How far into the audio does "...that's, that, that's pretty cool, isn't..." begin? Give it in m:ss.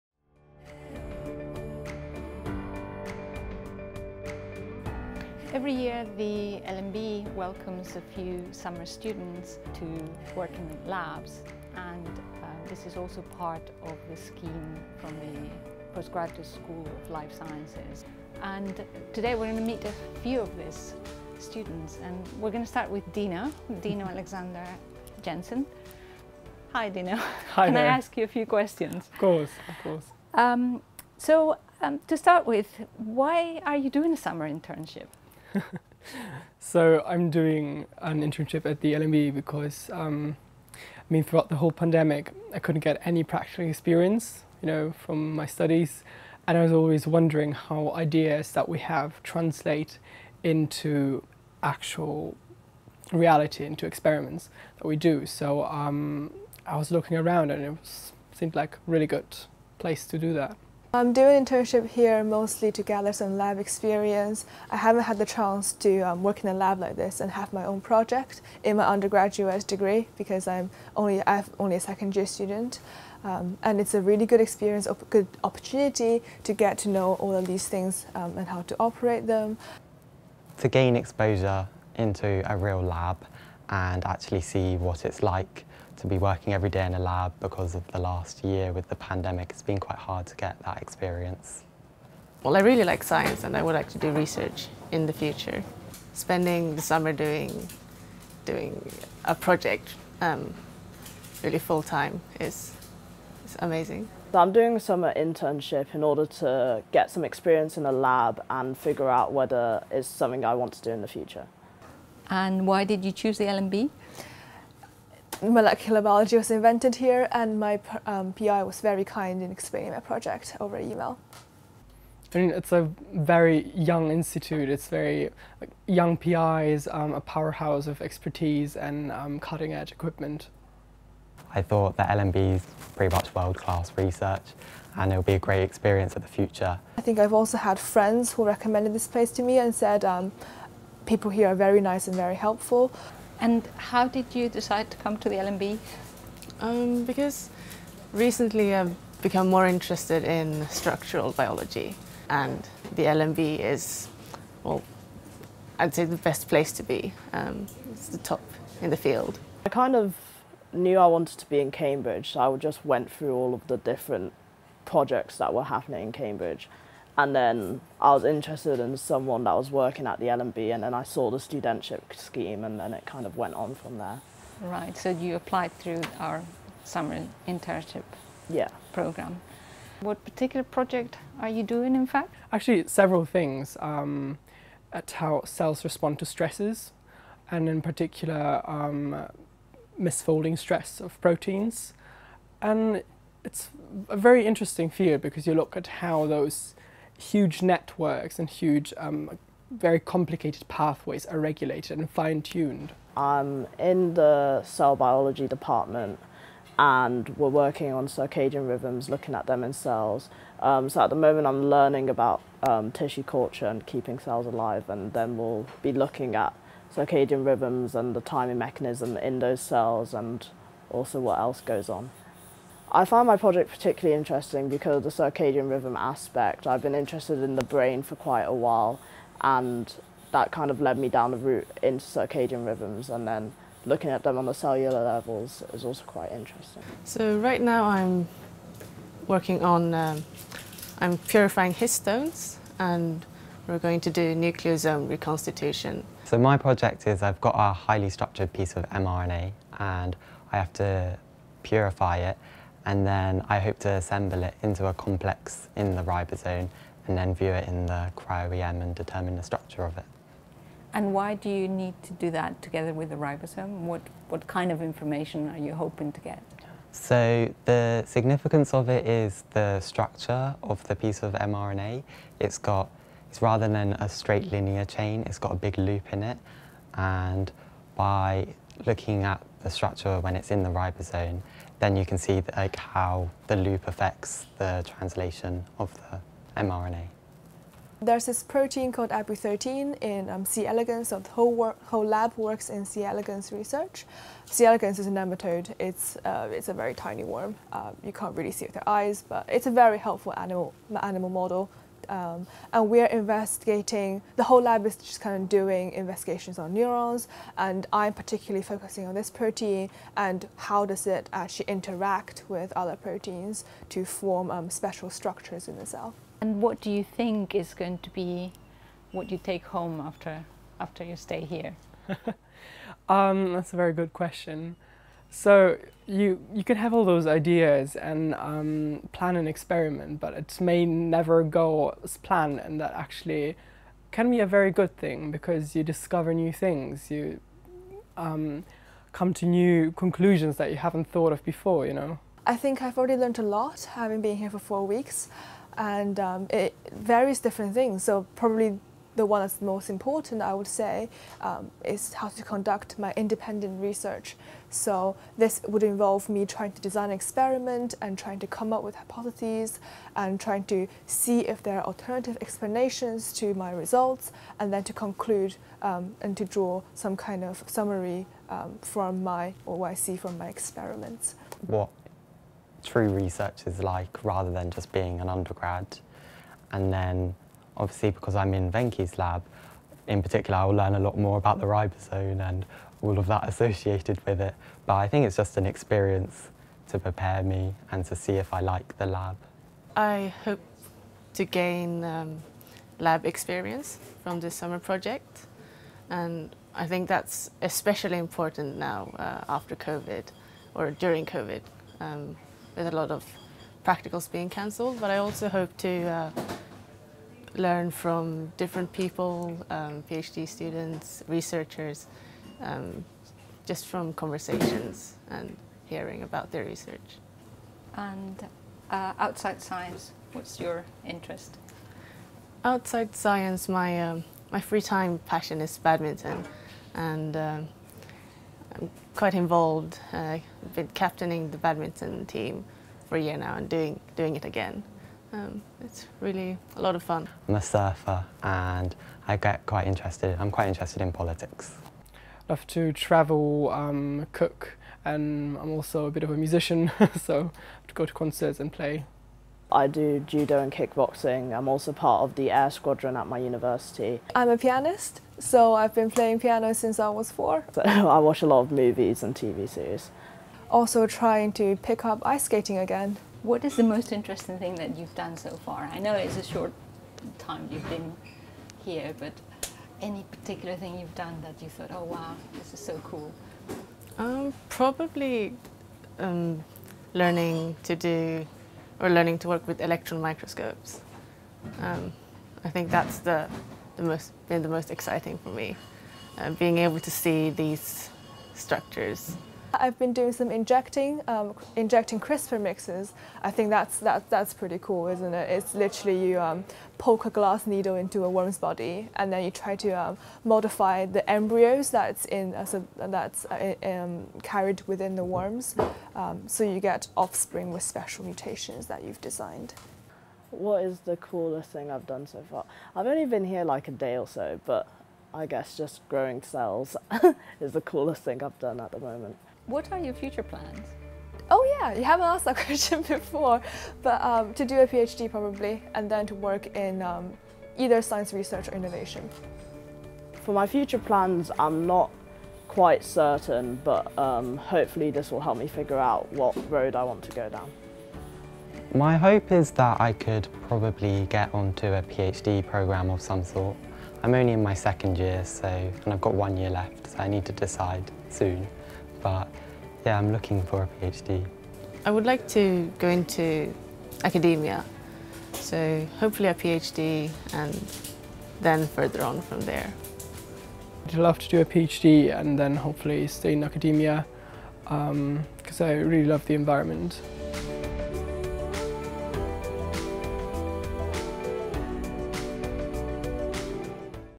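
8:13.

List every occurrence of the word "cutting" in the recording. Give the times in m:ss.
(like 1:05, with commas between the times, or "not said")
2:09.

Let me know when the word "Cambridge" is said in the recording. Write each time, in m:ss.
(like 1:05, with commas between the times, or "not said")
2:41, 2:46.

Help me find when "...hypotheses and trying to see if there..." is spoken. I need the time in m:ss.
5:58.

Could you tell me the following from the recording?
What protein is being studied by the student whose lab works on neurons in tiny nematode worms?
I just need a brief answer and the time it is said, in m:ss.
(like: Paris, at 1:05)
ABU13, at 4:49.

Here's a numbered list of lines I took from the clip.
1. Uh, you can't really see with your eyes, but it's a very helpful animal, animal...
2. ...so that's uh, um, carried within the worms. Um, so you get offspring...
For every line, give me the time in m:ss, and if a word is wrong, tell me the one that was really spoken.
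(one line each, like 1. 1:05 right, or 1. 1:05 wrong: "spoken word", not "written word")
1. 4:57 right
2. 8:22 right.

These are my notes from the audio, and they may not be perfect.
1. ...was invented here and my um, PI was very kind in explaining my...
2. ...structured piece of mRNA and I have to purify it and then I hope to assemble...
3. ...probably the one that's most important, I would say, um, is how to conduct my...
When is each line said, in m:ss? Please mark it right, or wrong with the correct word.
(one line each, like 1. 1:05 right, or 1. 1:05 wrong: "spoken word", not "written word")
1. 1:56 right
2. 4:08 right
3. 5:48 right.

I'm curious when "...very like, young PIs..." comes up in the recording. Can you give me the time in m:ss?
2:04.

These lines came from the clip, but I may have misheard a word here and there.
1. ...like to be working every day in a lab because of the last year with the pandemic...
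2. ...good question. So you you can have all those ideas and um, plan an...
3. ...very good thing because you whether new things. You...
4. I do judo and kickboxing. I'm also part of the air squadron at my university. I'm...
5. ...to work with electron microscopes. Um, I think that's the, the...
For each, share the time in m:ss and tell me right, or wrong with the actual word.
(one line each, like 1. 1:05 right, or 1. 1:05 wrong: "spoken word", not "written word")
1. 1:25 right
2. 5:23 right
3. 5:34 wrong: "discover", not "whether"
4. 7:29 right
5. 7:59 right.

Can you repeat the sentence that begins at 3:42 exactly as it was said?
I find my project particularly interesting because of the circadian rhythm aspect.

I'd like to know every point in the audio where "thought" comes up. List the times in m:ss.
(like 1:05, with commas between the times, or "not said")
2:11, 5:41, 7:51.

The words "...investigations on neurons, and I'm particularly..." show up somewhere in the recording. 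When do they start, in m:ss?
5:05.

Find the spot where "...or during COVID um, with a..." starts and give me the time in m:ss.
6:40.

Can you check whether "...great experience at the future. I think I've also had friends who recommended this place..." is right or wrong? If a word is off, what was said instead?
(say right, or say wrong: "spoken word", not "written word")
right.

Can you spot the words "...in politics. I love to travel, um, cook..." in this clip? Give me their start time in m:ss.
7:21.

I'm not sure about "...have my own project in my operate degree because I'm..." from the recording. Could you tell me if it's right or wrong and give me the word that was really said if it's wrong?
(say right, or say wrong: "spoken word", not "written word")
wrong: "undergraduate", not "operate".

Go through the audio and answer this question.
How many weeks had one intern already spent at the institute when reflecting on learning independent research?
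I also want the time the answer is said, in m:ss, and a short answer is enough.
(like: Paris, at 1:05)
4, at 5:44.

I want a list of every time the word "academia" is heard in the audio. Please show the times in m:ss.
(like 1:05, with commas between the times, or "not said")
9:14, 9:23.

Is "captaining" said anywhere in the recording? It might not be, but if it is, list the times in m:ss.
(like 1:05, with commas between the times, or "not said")
7:10.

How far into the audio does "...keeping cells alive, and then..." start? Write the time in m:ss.
3:33.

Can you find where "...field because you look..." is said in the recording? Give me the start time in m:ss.
3:14.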